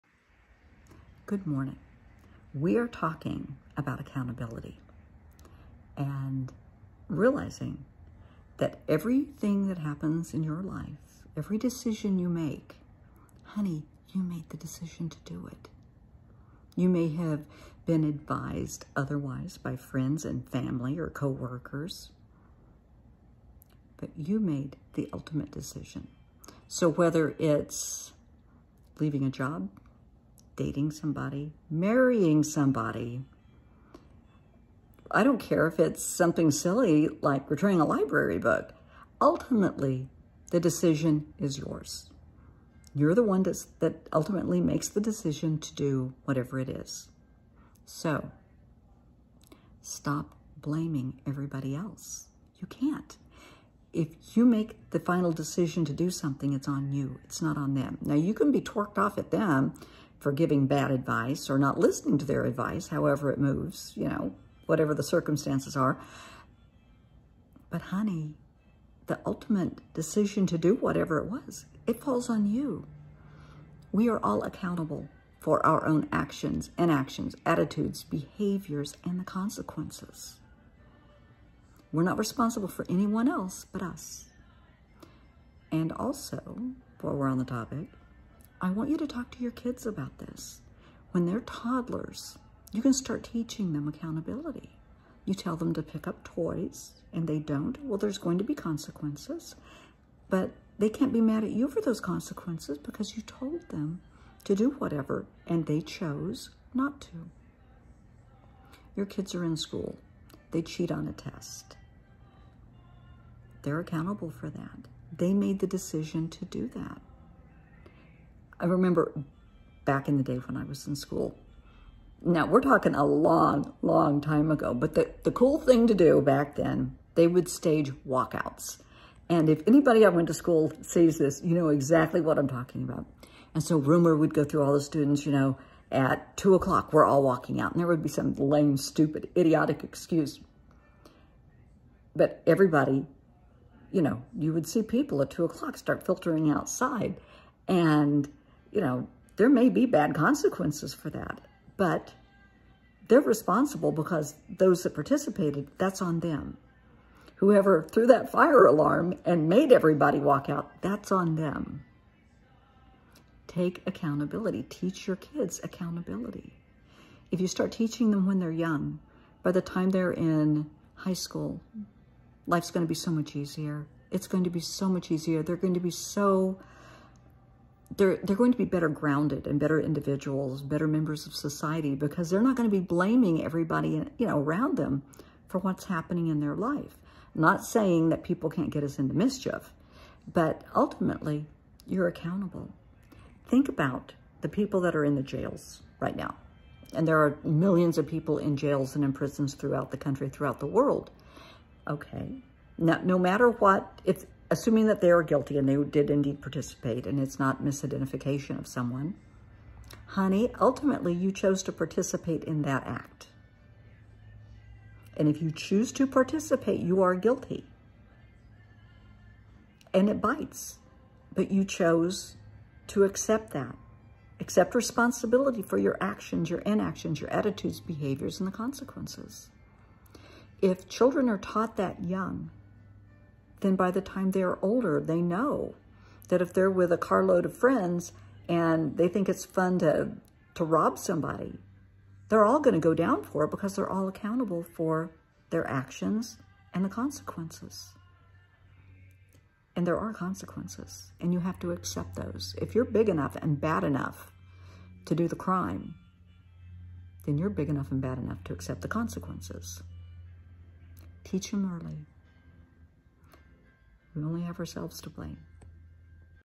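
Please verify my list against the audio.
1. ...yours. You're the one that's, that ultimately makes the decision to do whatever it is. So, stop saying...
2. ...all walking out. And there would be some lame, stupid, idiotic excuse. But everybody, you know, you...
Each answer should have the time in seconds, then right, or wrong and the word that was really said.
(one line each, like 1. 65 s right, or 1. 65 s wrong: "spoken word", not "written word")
1. 41 s wrong: "blaming", not "saying"
2. 137 s right.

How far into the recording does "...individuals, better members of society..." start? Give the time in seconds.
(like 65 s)
179 s.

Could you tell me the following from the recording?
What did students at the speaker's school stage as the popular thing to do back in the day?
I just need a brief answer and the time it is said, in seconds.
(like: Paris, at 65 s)
walkouts, at 128 s.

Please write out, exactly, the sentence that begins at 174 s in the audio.
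It's going to be so much easier.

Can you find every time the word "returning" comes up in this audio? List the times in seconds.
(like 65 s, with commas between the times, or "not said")
37 s.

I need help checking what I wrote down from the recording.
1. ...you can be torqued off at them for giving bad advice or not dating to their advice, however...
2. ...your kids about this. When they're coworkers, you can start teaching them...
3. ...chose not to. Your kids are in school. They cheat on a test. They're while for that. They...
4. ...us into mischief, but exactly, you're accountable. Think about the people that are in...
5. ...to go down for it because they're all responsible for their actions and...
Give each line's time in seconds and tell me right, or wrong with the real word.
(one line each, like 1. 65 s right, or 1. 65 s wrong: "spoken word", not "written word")
1. 58 s wrong: "listening", not "dating"
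2. 89 s wrong: "toddlers", not "coworkers"
3. 105 s wrong: "accountable", not "while"
4. 188 s wrong: "ultimately", not "exactly"
5. 242 s wrong: "accountable", not "responsible".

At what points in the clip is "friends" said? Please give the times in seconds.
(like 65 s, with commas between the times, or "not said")
19 s, 237 s.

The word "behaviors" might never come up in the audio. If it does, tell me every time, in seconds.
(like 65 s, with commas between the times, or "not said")
78 s, 227 s.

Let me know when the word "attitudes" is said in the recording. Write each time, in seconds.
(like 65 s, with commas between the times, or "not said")
77 s, 227 s.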